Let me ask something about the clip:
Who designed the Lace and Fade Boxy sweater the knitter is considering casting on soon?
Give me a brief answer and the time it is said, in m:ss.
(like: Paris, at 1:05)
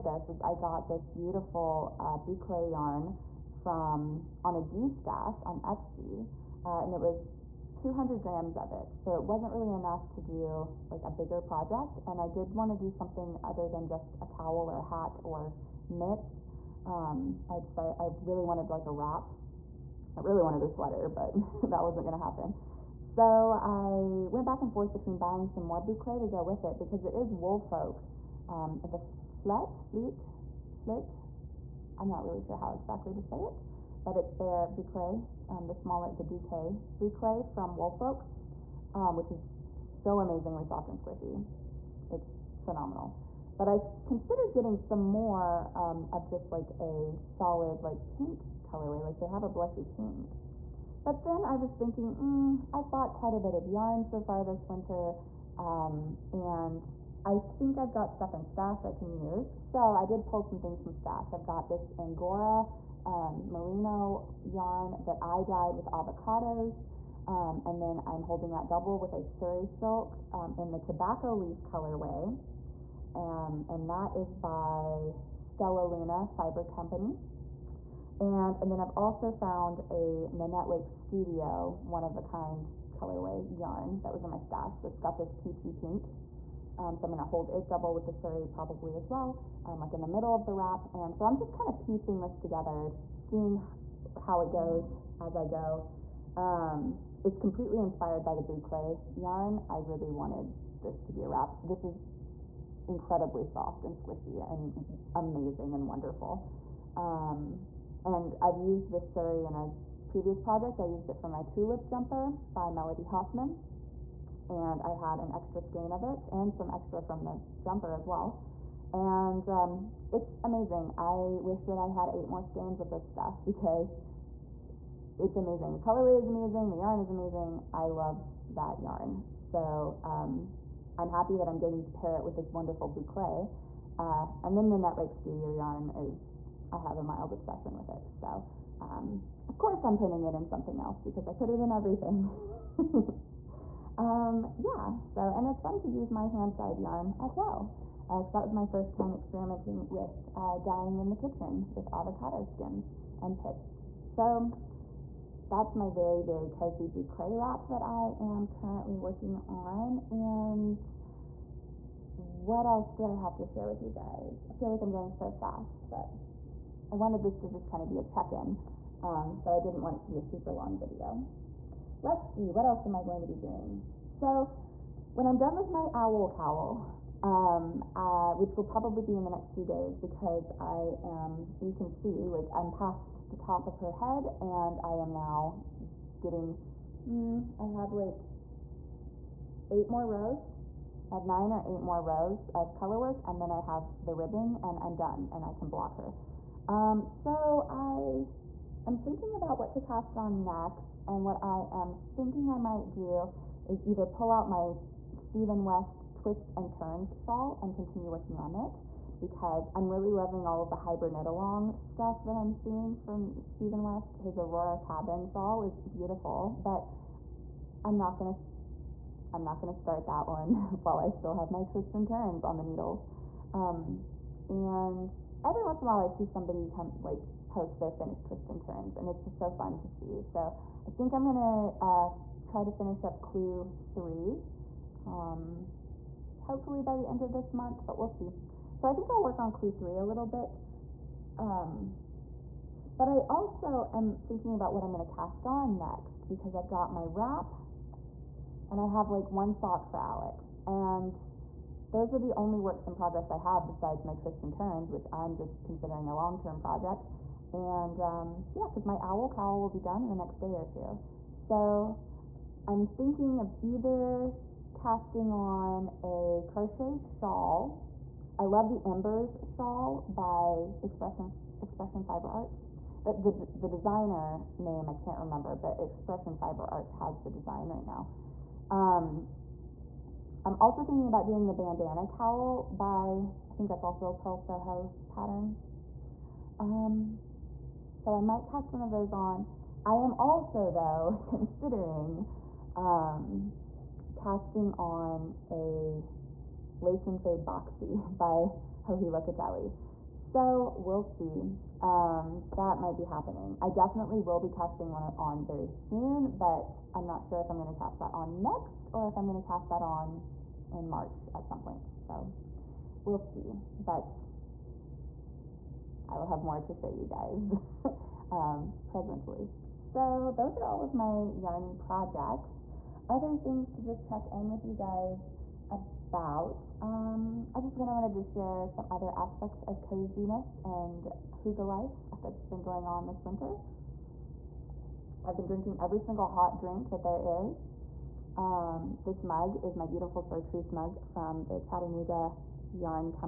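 Joji Locatelli, at 4:58.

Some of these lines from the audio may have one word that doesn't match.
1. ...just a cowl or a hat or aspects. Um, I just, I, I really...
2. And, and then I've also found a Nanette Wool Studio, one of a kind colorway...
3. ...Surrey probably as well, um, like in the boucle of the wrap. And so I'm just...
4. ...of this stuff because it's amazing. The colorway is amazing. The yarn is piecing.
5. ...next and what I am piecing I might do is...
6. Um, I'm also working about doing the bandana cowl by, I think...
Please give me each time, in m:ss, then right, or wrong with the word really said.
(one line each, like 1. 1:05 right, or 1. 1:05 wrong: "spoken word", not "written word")
1. 0:13 wrong: "mitts", not "aspects"
2. 1:18 wrong: "Wake", not "Wool"
3. 1:28 wrong: "middle", not "boucle"
4. 2:02 wrong: "amazing", not "piecing"
5. 3:20 wrong: "thinking", not "piecing"
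6. 4:38 wrong: "thinking", not "working".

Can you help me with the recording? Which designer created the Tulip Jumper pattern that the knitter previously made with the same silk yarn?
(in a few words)
Melody Hoffman.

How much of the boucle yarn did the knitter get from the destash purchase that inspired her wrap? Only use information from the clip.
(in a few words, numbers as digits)
200 grams.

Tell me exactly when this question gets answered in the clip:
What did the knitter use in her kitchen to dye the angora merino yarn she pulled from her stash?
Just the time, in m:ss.
1:05.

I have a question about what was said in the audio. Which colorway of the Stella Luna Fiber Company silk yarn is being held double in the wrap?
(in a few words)
tobacco leaf.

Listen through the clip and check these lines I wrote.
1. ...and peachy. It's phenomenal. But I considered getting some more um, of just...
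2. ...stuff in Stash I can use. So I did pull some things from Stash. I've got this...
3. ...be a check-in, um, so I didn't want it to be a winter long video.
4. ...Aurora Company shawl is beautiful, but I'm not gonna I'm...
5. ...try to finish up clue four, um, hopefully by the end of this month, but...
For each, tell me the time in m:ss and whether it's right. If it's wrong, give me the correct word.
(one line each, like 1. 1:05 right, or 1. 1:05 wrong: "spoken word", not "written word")
1. 0:40 wrong: "squishy", not "peachy"
2. 0:58 right
3. 2:47 wrong: "super", not "winter"
4. 3:34 wrong: "Cabin", not "Company"
5. 3:52 wrong: "three", not "four".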